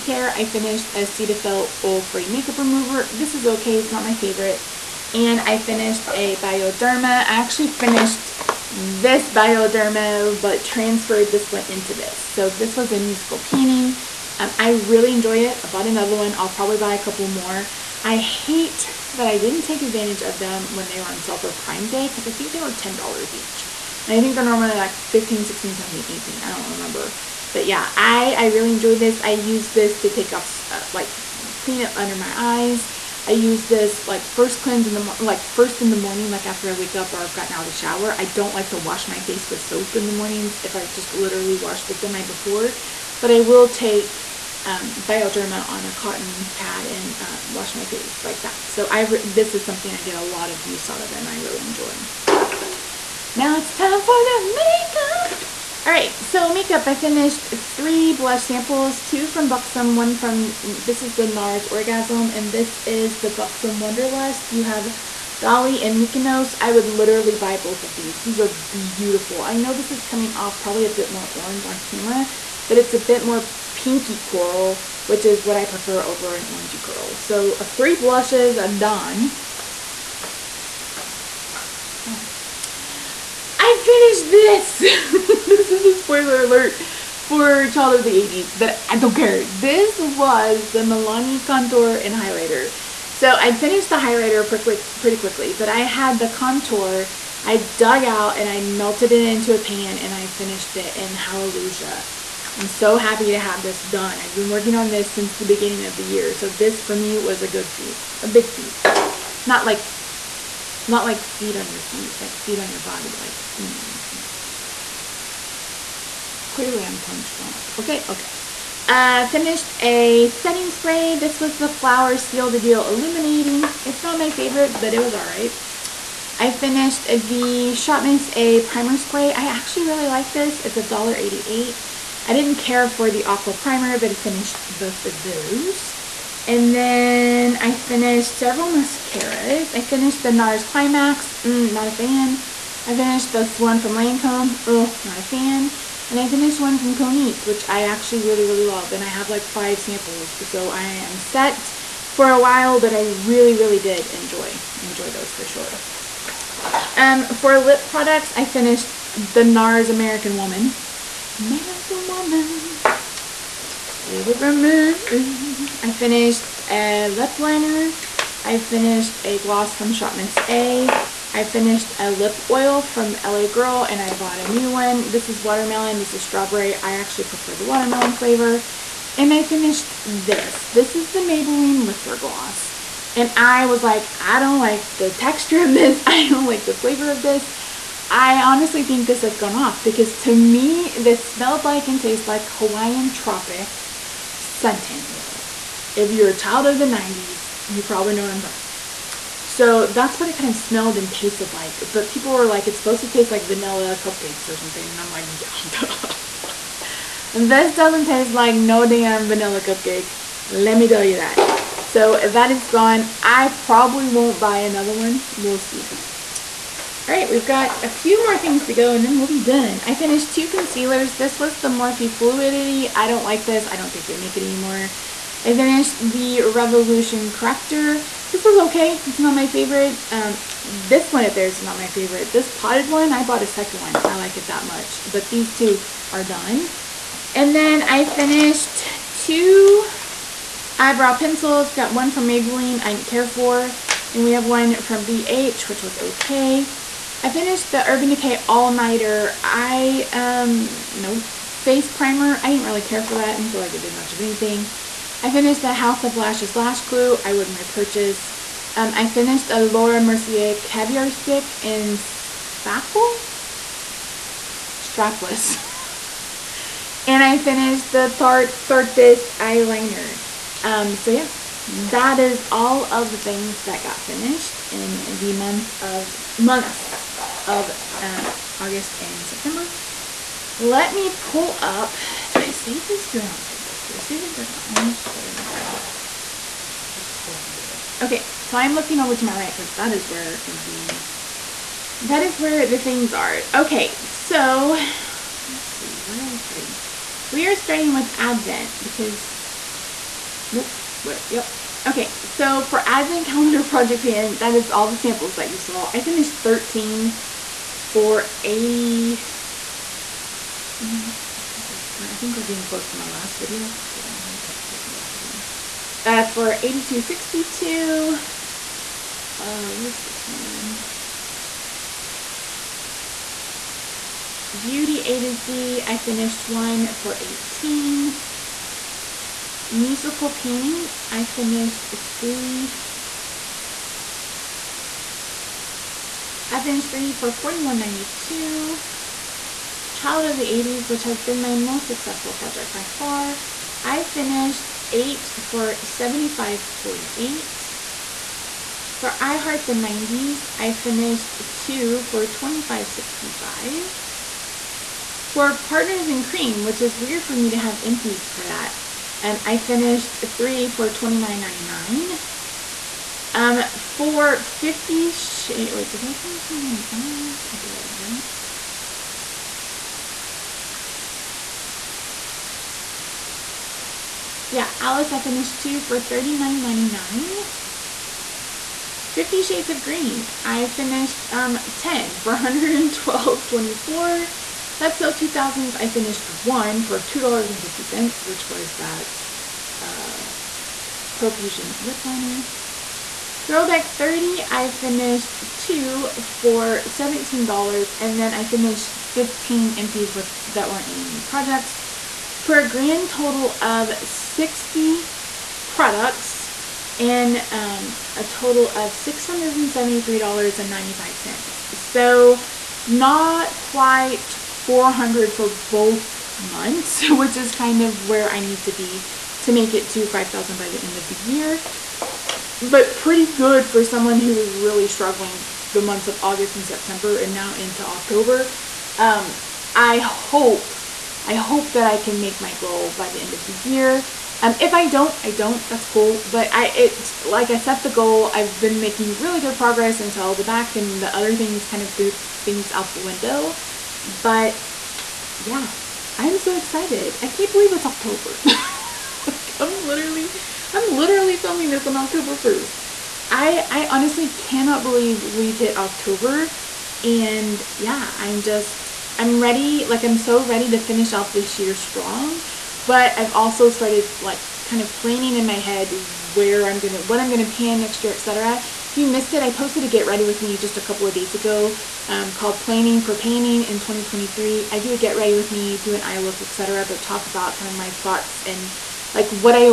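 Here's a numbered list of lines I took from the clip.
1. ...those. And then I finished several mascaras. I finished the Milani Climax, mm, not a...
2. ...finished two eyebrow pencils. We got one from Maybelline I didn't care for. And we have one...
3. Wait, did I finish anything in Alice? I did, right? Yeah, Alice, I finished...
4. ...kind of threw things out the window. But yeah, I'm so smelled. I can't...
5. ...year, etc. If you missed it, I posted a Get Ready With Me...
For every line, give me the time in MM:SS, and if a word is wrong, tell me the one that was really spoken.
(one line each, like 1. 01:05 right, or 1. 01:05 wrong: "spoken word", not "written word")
1. 02:15 wrong: "NARS", not "Milani"
2. 03:58 right
3. 06:05 right
4. 07:21 wrong: "excited", not "smelled"
5. 07:48 right.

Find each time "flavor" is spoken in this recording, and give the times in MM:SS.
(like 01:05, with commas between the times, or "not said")
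02:58, 03:06.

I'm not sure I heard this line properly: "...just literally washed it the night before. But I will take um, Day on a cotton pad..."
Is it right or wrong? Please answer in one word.
wrong.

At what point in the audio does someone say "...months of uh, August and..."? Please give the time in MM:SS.
04:36.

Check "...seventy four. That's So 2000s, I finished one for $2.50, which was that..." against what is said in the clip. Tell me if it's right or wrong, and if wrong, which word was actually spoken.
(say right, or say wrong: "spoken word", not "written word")
wrong: "twenty", not "seventy".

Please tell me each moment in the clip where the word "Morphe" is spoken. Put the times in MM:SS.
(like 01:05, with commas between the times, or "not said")
03:41.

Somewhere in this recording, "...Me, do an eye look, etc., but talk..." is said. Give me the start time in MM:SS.
07:55.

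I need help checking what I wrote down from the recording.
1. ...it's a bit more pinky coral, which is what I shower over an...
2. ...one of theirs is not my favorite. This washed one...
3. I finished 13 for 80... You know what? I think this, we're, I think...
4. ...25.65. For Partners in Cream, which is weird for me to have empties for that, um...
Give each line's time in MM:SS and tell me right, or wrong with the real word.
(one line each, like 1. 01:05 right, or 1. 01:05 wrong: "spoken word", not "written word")
1. 01:12 wrong: "prefer", not "shower"
2. 03:51 wrong: "potted", not "washed"
3. 05:05 right
4. 05:52 right.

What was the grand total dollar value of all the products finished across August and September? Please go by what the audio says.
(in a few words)
$673.95.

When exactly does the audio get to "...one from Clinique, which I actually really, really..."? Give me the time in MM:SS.
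02:26.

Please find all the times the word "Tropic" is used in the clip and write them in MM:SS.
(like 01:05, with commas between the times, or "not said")
03:13.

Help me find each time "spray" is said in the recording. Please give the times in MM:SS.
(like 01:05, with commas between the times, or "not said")
02:00, 02:08.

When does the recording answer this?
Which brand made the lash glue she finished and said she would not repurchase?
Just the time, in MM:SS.
04:15.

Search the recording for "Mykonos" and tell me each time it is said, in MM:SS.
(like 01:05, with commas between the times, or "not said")
01:05.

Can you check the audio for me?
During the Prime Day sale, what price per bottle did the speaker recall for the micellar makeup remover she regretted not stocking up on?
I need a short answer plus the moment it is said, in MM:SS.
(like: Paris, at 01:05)
$10, at 00:22.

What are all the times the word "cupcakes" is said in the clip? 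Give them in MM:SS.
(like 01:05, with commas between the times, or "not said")
03:24, 03:29.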